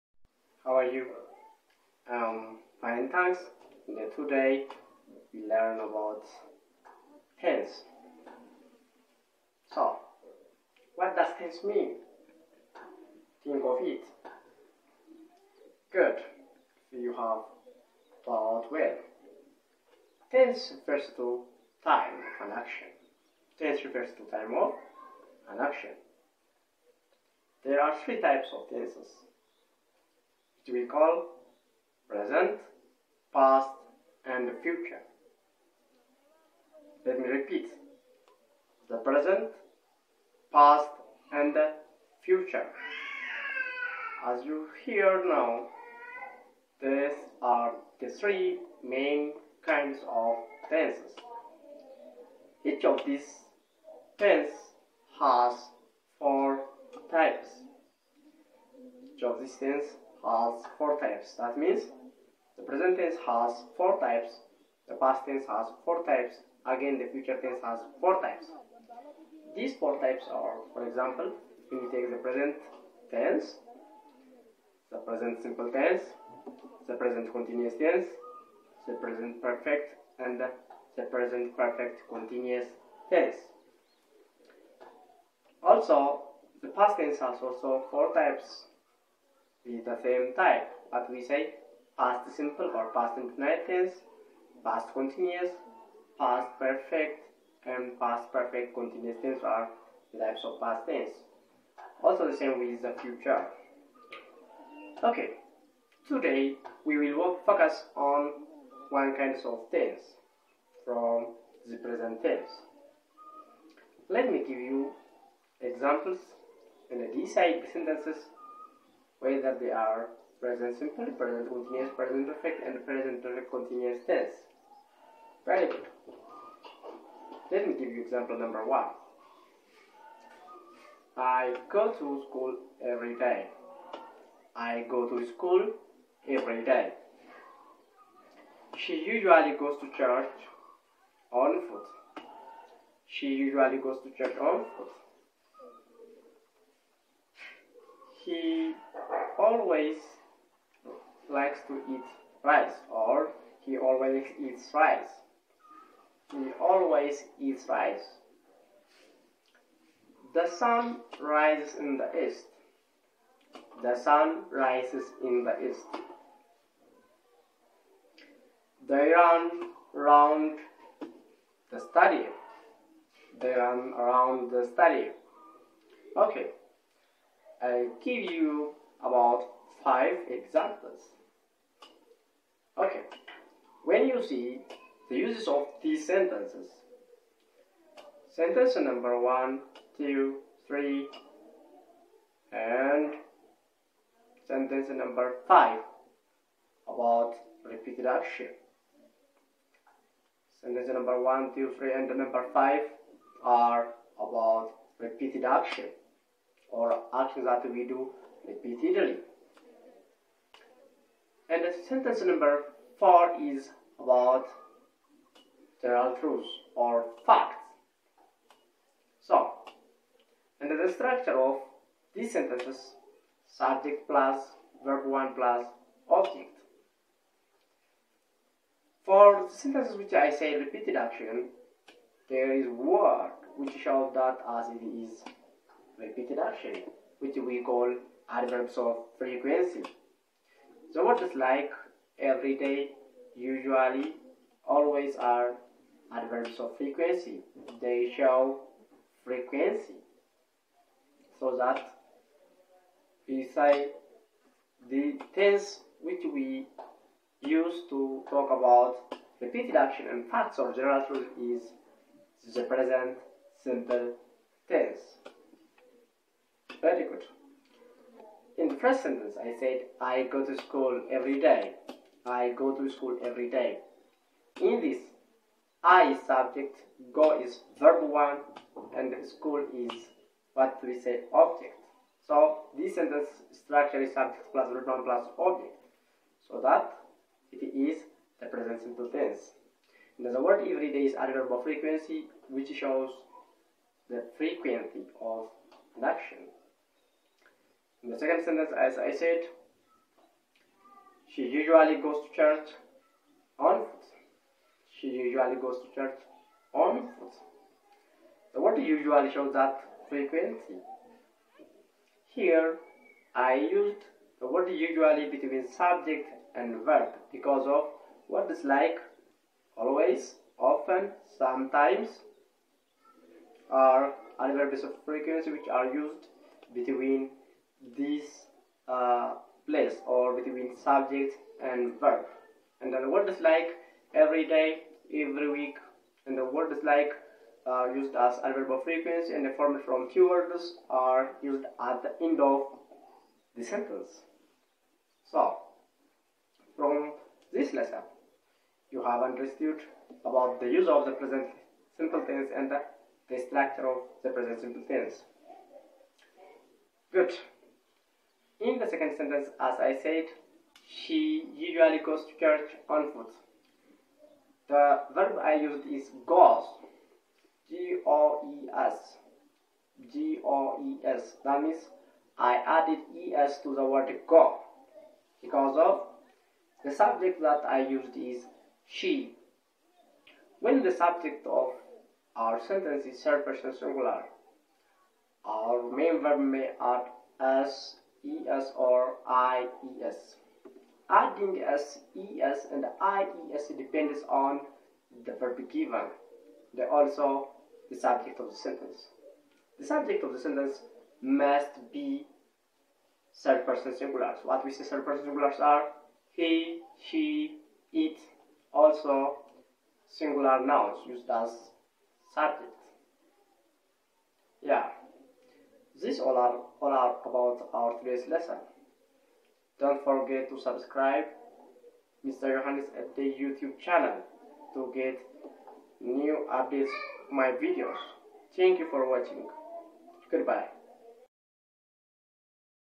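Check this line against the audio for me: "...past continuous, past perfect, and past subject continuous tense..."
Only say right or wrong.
wrong.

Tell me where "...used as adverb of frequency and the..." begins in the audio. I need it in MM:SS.
05:37.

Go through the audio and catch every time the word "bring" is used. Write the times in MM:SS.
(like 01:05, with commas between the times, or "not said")
not said.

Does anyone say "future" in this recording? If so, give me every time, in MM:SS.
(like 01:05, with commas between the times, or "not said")
00:34, 00:42, 01:07, 01:43.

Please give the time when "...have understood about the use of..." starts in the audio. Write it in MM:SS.
05:49.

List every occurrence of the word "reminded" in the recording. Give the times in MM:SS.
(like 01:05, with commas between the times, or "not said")
not said.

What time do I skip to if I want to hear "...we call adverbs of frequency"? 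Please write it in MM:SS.
03:57.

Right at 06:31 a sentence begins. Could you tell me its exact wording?
Adding S E S ES and IES depends on the verb given.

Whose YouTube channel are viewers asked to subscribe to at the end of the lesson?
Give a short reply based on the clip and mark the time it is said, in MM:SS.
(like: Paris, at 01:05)
Mr. Johannes, at 07:02.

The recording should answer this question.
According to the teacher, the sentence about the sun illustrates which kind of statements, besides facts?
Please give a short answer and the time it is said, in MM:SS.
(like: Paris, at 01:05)
General truths, at 03:35.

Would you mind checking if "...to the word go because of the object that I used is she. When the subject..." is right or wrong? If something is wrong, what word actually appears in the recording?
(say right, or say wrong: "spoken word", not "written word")
wrong: "subject", not "object".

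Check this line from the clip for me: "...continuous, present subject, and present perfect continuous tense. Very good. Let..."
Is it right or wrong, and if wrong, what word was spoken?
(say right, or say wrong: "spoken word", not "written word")
wrong: "perfect", not "subject".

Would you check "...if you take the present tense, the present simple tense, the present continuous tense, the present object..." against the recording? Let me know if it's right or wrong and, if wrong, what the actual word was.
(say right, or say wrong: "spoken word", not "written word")
wrong: "perfect", not "object".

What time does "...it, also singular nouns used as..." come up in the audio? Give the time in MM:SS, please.
06:47.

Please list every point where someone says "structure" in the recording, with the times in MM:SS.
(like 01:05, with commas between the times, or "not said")
03:40, 04:43, 05:53.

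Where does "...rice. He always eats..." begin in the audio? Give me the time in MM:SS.
02:34.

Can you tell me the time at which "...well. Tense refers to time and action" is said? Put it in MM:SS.
00:18.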